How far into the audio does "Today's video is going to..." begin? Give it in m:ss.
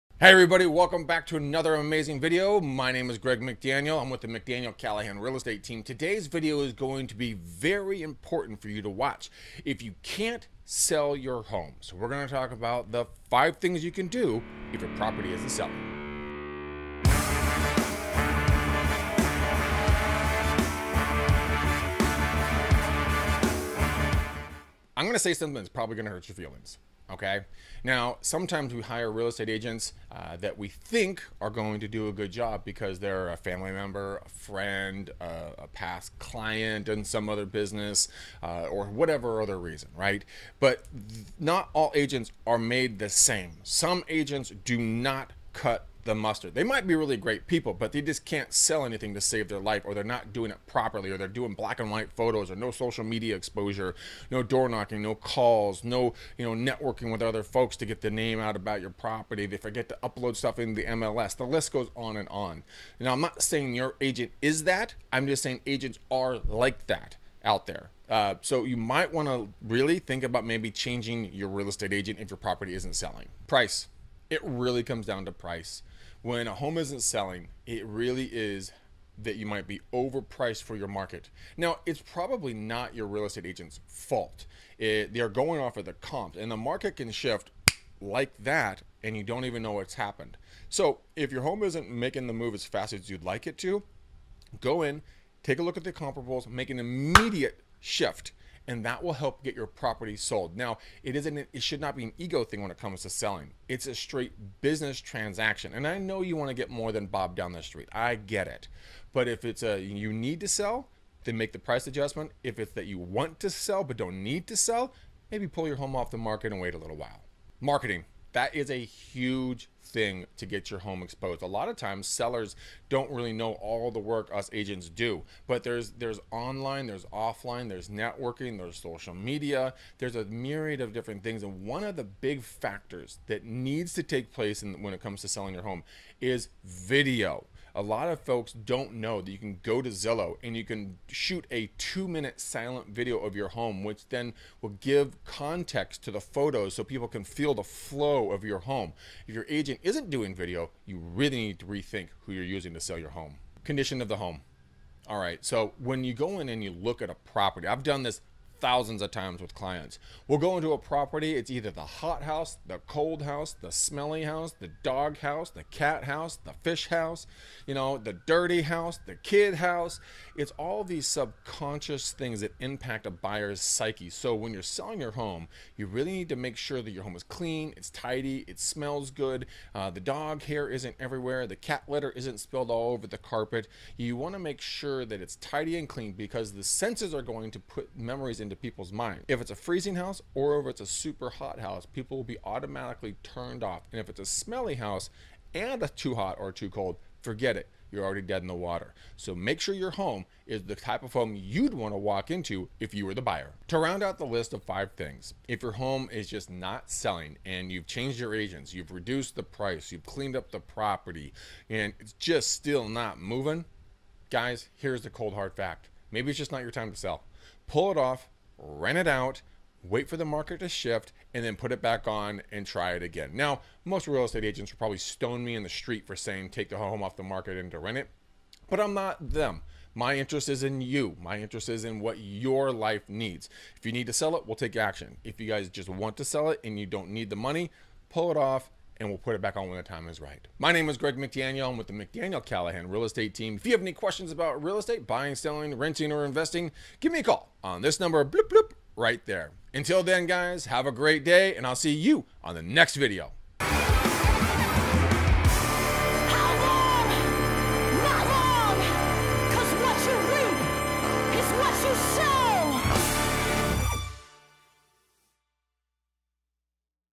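0:05.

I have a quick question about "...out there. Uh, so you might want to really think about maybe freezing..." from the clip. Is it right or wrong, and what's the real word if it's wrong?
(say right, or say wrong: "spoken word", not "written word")
wrong: "changing", not "freezing".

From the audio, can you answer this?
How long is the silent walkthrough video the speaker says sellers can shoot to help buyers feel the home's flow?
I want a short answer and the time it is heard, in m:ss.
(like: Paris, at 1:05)
2 minutes, at 2:21.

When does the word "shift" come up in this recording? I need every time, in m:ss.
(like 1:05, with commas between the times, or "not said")
1:27, 1:37, 3:40.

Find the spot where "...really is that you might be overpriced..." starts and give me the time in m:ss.
1:17.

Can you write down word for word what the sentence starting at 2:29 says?
If your agent isn't doing video, you really need to rethink who you're using to sell your home.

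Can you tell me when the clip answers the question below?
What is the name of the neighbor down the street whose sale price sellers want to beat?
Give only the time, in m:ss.
1:47.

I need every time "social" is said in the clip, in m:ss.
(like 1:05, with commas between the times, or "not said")
0:52, 2:08.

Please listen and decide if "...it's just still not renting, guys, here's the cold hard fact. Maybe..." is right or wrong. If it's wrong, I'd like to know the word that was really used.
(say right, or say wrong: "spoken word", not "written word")
wrong: "moving", not "renting".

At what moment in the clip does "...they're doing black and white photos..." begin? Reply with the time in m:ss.
0:51.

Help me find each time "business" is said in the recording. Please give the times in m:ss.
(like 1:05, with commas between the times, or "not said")
0:37, 1:44.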